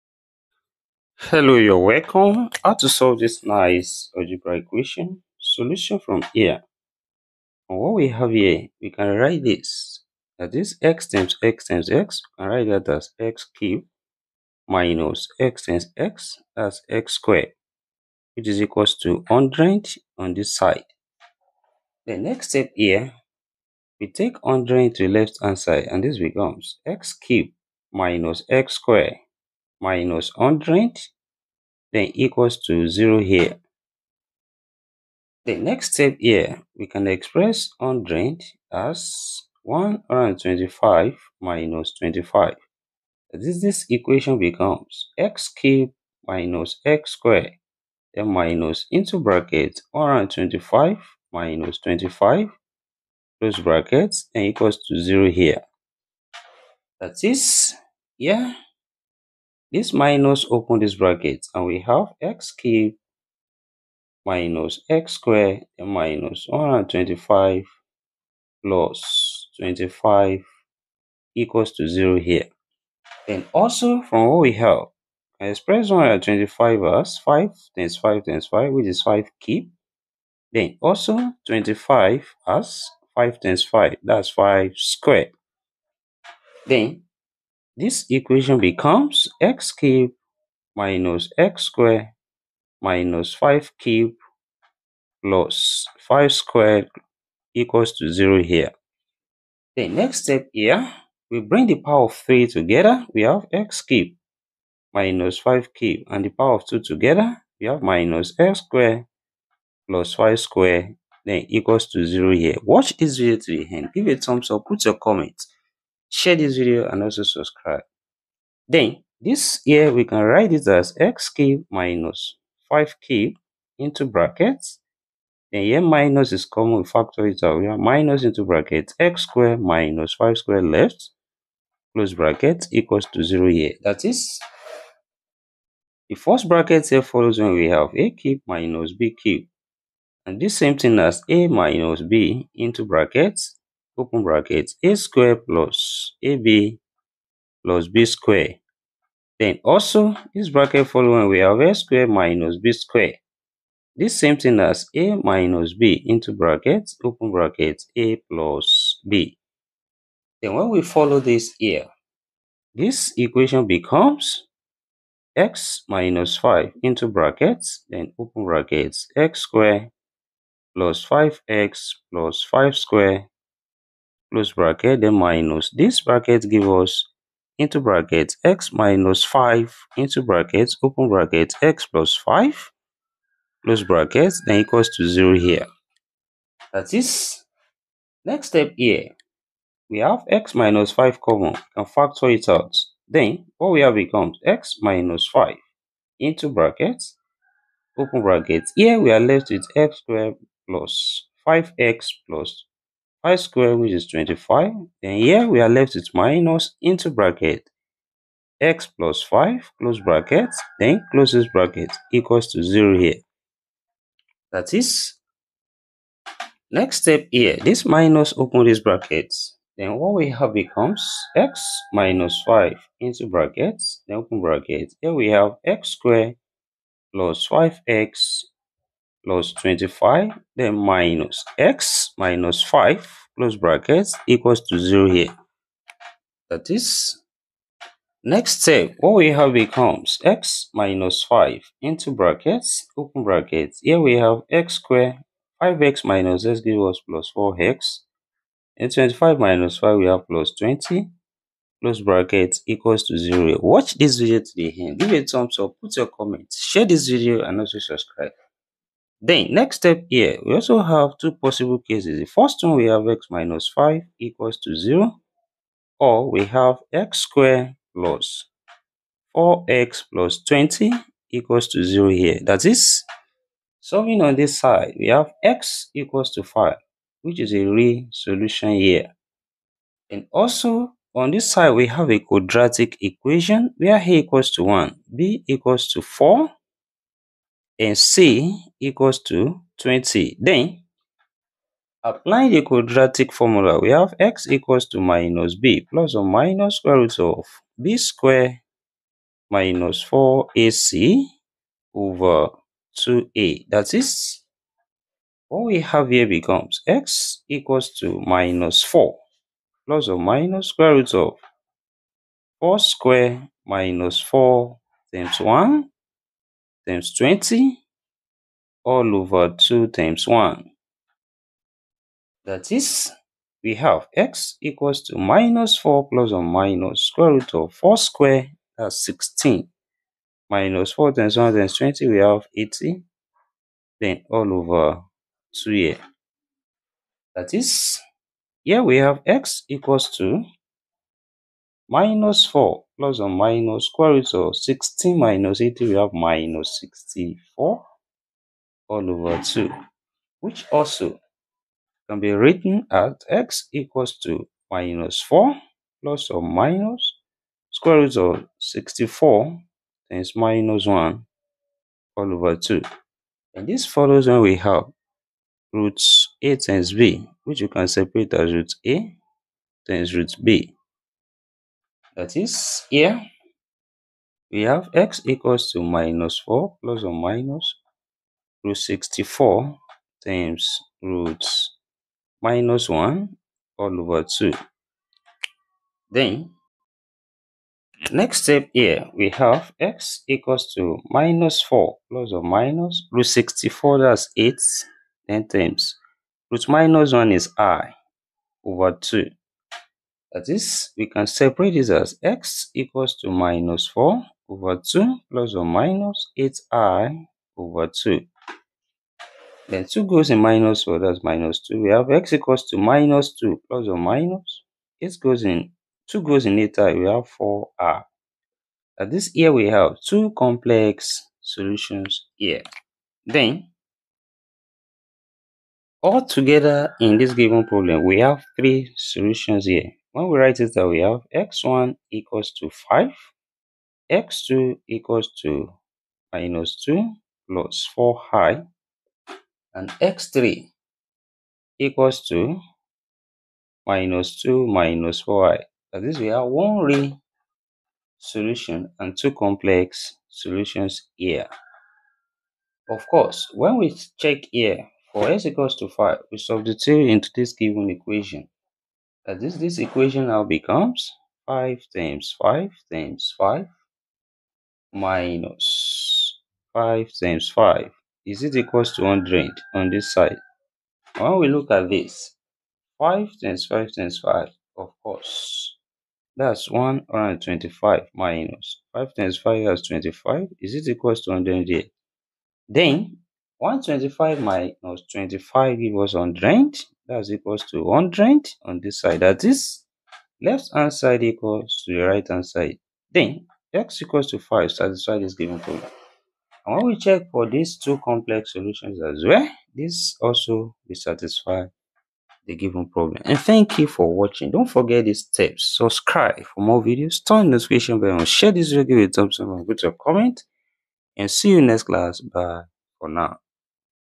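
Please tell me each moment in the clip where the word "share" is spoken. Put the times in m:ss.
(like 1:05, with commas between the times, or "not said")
1:56, 4:16, 8:28.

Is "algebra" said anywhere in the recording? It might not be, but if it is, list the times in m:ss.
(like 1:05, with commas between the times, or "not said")
0:04.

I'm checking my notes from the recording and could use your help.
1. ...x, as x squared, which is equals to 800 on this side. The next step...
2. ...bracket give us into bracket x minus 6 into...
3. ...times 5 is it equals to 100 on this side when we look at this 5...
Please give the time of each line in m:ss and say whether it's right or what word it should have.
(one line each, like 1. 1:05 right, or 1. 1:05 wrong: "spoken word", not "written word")
1. 0:15 wrong: "100", not "800"
2. 2:56 wrong: "5", not "6"
3. 7:47 right.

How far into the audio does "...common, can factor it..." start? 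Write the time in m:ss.
3:11.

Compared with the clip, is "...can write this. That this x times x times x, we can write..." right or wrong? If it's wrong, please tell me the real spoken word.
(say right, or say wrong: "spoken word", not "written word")
right.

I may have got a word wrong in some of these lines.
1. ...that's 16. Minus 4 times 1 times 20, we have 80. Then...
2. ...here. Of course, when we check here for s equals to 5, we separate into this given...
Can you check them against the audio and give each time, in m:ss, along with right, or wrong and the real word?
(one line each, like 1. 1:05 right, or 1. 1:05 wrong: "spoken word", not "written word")
1. 5:28 right
2. 7:31 wrong: "substitute", not "separate".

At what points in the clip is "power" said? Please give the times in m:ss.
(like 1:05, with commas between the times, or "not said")
1:41, 1:46.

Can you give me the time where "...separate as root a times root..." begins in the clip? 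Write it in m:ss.
6:07.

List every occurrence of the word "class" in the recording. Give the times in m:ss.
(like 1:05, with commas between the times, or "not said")
8:31.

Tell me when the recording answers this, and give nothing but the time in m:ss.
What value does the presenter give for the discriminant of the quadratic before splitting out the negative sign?
5:46.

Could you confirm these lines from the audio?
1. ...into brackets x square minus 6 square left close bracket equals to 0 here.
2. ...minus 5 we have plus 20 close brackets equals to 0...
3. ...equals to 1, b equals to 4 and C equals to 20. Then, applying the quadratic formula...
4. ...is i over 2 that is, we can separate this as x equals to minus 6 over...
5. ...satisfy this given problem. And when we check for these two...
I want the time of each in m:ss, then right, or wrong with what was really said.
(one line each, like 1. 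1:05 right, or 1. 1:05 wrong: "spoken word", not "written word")
1. 2:08 wrong: "5", not "6"
2. 4:09 right
3. 4:44 right
4. 6:37 wrong: "4", not "6"
5. 8:14 right.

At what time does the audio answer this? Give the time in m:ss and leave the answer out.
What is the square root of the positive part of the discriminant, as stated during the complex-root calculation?
6:33.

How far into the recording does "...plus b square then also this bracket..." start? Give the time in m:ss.
2:27.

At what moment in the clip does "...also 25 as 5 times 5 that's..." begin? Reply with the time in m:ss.
1:20.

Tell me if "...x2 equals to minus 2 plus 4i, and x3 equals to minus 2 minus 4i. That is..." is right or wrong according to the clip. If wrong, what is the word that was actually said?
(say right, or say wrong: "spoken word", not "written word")
right.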